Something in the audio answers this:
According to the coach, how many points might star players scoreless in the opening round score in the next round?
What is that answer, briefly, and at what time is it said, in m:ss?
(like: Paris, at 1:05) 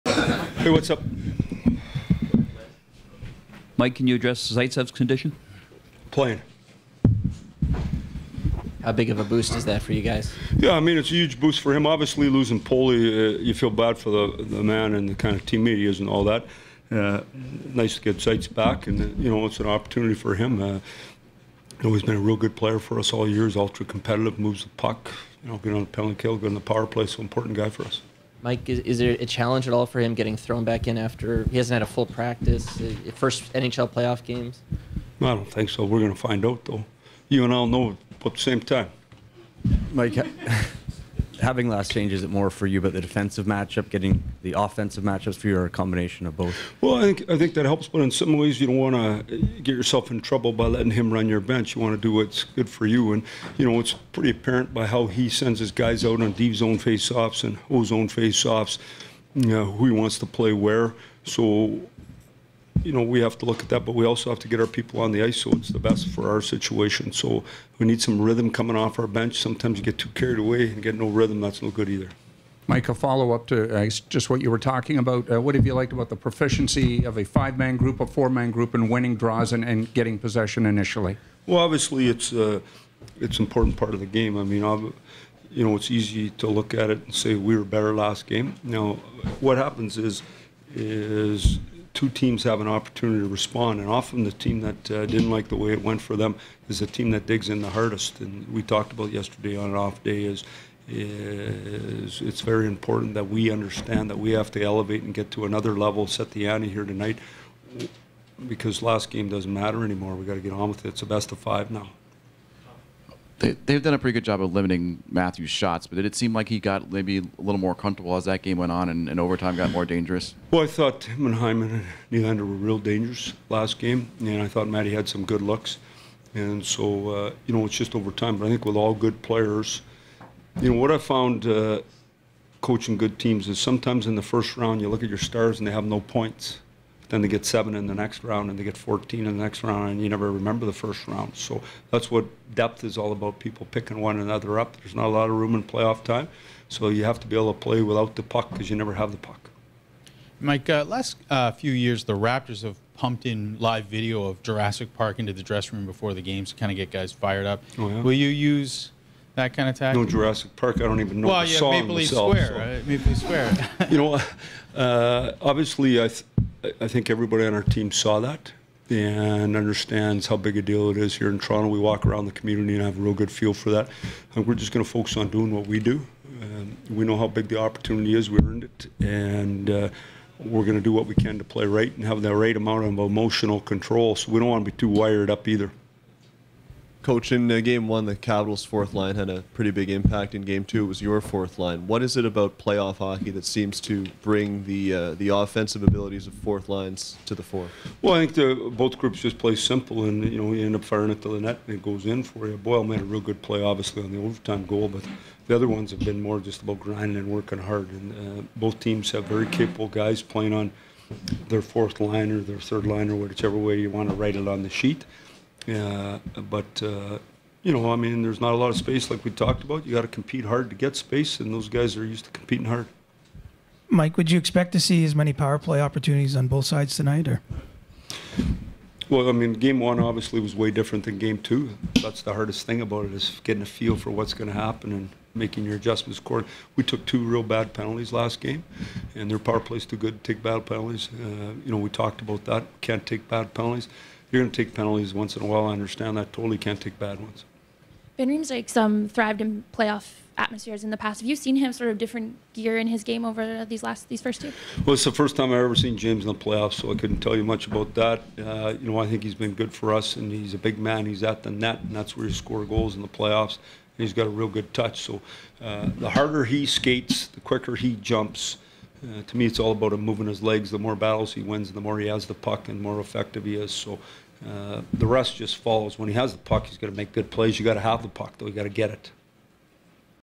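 7, at 2:17.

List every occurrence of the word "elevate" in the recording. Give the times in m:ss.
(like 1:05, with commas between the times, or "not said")
1:44.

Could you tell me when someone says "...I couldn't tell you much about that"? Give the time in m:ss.
4:16.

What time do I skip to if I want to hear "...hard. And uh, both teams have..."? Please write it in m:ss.
3:27.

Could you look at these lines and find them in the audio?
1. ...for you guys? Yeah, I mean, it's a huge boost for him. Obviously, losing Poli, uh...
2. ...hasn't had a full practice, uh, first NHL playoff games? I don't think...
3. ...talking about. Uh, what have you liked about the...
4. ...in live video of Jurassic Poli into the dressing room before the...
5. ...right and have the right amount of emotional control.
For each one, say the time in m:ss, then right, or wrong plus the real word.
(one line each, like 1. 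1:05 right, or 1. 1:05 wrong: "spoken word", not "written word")
1. 0:09 right
2. 0:31 right
3. 1:14 right
4. 2:33 wrong: "Park", not "Poli"
5. 3:01 right.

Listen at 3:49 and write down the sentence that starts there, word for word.
Well, I mean, game one obviously was way different than game two.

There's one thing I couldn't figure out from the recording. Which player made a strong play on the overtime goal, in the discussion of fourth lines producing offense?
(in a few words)
Boyle.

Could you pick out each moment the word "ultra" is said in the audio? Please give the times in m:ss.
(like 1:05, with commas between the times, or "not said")
0:23.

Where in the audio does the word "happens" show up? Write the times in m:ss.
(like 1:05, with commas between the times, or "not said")
1:29, 3:54.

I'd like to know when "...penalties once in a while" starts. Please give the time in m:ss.
4:04.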